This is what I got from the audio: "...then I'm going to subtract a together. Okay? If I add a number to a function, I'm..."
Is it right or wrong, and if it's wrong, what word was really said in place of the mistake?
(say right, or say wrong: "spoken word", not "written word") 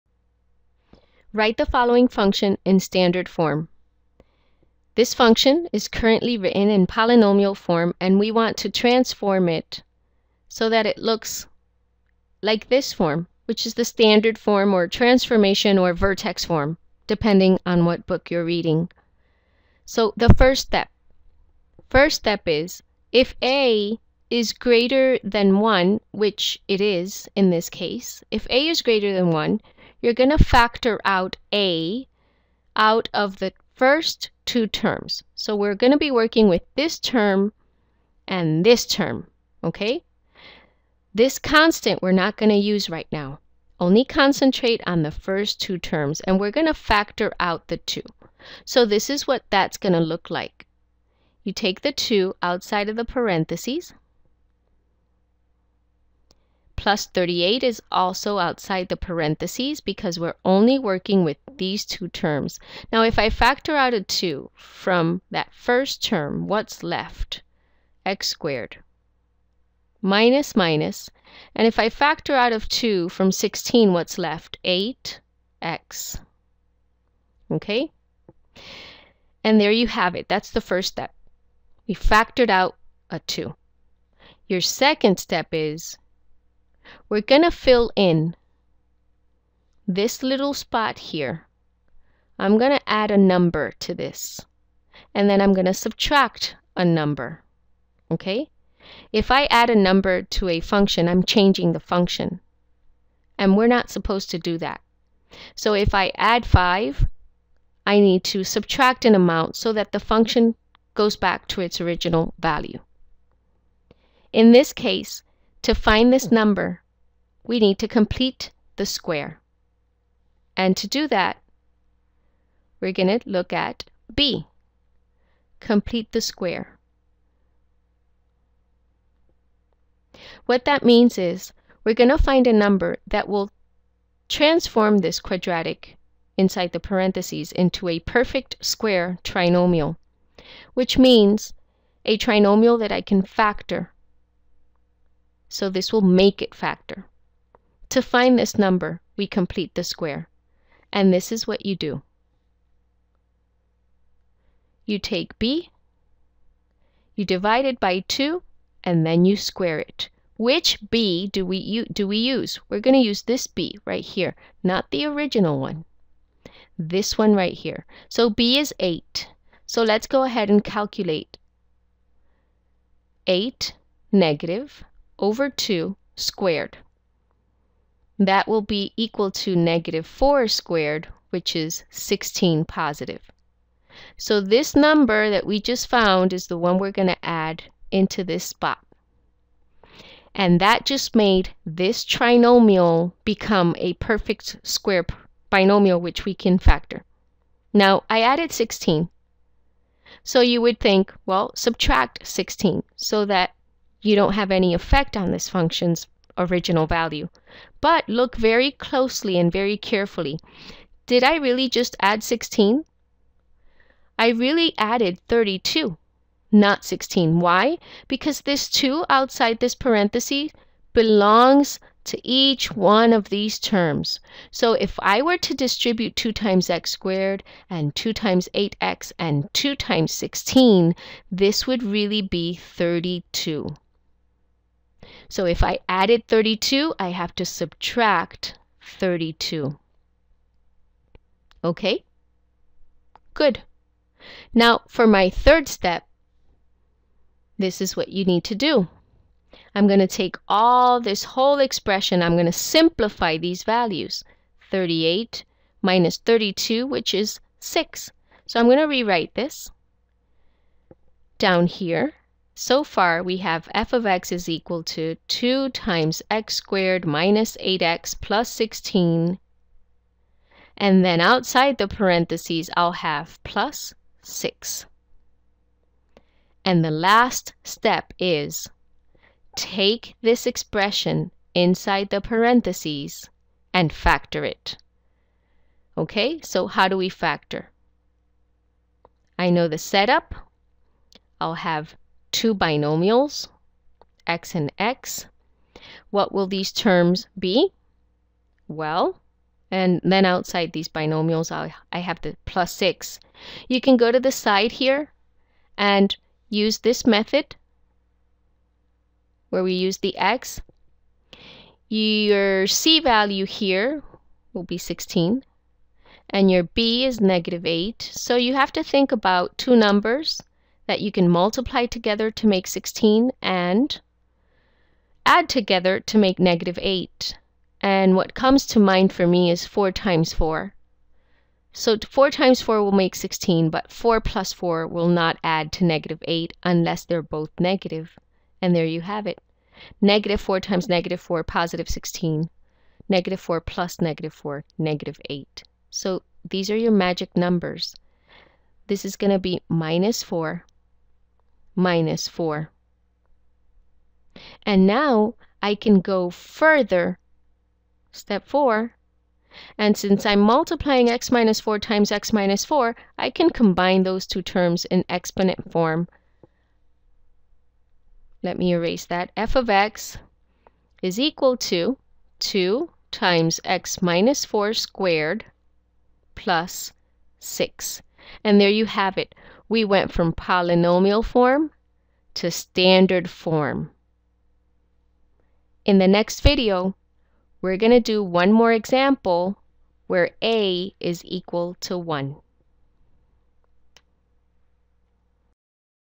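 wrong: "number", not "together".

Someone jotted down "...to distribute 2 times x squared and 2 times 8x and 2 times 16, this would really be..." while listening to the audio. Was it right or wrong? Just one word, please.
right.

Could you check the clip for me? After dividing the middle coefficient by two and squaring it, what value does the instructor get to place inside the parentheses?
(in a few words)
16.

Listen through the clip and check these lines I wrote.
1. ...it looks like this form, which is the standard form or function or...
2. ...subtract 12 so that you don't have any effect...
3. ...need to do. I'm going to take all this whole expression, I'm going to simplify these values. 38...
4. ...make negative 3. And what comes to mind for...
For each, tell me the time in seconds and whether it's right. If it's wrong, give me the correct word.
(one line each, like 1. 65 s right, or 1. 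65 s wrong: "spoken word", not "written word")
1. 10 s wrong: "transformation", not "function"
2. 201 s wrong: "16", not "12"
3. 248 s right
4. 326 s wrong: "8", not "3".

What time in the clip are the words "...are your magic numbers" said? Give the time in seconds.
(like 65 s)
346 s.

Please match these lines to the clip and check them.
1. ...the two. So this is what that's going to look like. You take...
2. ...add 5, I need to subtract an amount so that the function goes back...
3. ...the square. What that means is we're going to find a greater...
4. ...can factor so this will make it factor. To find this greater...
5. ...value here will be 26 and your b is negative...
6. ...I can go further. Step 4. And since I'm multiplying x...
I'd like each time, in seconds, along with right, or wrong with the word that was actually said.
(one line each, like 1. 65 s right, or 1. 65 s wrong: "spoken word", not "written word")
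1. 47 s right
2. 106 s right
3. 126 s wrong: "number", not "greater"
4. 143 s wrong: "number", not "greater"
5. 313 s wrong: "16", not "26"
6. 355 s right.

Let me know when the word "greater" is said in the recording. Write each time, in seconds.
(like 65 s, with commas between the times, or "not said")
24 s, 28 s.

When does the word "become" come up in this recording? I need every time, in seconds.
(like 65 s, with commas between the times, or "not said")
193 s.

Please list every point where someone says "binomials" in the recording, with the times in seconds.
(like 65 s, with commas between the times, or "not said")
195 s, 292 s, 300 s.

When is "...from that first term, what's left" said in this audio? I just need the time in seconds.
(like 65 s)
64 s.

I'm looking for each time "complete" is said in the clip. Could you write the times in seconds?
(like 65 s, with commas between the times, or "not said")
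117 s, 125 s, 149 s.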